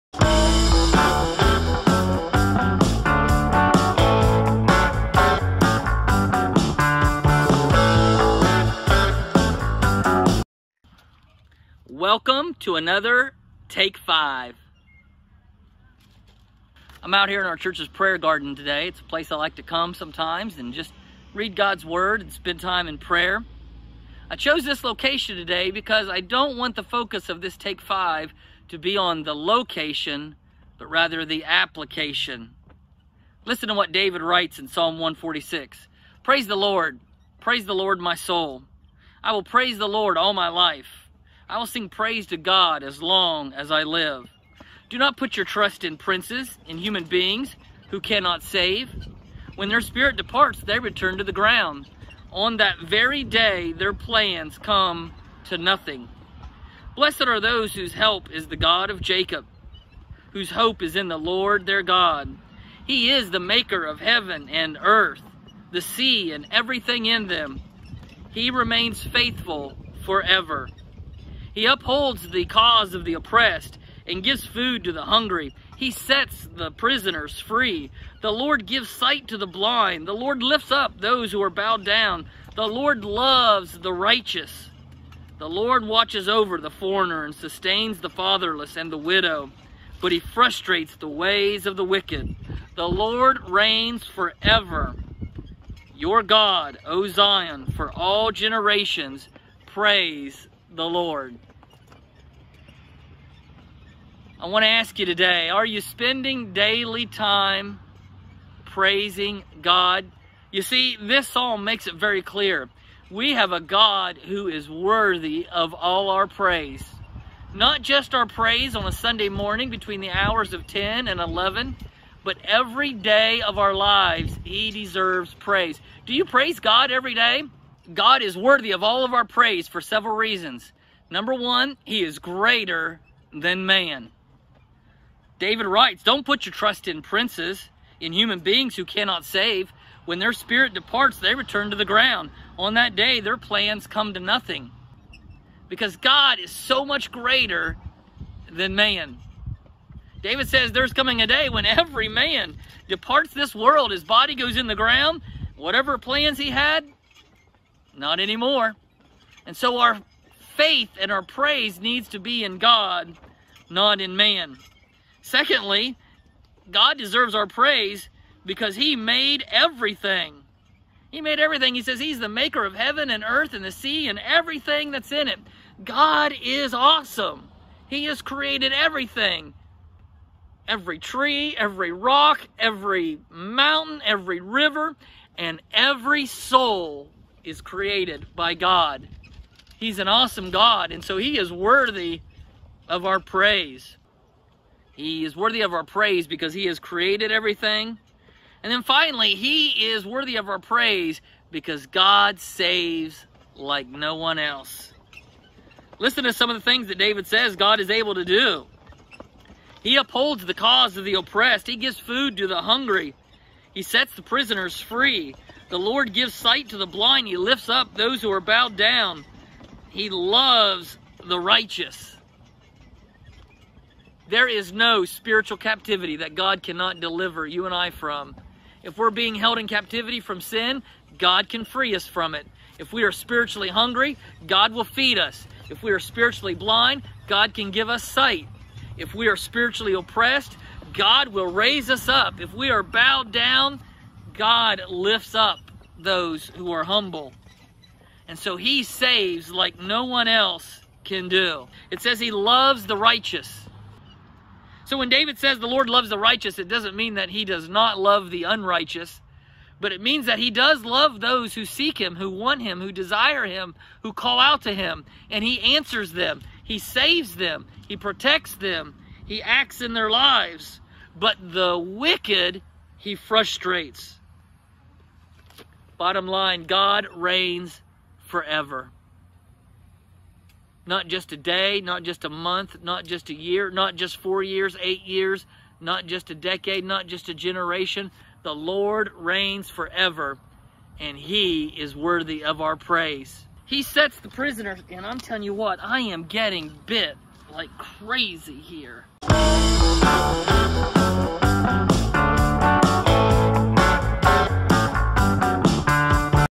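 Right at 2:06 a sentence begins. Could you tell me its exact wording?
Do you praise God every day?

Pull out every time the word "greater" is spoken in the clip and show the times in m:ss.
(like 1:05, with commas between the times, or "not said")
2:12, 2:27.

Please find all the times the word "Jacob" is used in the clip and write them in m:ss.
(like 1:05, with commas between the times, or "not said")
0:59.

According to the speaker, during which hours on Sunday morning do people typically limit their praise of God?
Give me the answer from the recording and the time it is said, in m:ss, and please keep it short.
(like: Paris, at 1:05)
10 and 11, at 2:00.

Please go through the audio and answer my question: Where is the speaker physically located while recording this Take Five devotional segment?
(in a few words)
church's prayer garden.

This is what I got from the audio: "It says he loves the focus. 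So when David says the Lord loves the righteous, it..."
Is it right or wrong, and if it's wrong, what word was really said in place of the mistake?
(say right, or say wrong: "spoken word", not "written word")
wrong: "righteous", not "focus".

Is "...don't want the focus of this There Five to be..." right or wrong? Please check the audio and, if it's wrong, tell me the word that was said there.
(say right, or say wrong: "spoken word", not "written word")
wrong: "Take", not "There".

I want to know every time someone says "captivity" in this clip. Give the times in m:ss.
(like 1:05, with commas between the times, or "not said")
3:45, 3:49.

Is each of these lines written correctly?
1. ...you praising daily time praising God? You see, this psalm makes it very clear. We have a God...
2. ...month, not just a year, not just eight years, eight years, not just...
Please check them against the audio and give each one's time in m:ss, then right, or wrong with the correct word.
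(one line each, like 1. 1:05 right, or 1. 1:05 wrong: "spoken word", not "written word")
1. 1:45 wrong: "spending", not "praising"
2. 4:42 wrong: "four", not "eight".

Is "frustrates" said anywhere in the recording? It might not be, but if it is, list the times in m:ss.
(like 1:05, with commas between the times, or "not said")
1:30, 4:33.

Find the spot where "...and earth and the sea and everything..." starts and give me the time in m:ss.
2:53.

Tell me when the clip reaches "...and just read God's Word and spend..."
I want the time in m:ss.
0:20.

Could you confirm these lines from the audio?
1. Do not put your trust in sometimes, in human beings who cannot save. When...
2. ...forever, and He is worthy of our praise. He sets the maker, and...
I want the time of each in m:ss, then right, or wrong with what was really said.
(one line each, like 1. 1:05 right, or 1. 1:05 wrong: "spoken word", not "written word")
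1. 0:44 wrong: "princes", not "sometimes"
2. 4:49 wrong: "prisoner", not "maker".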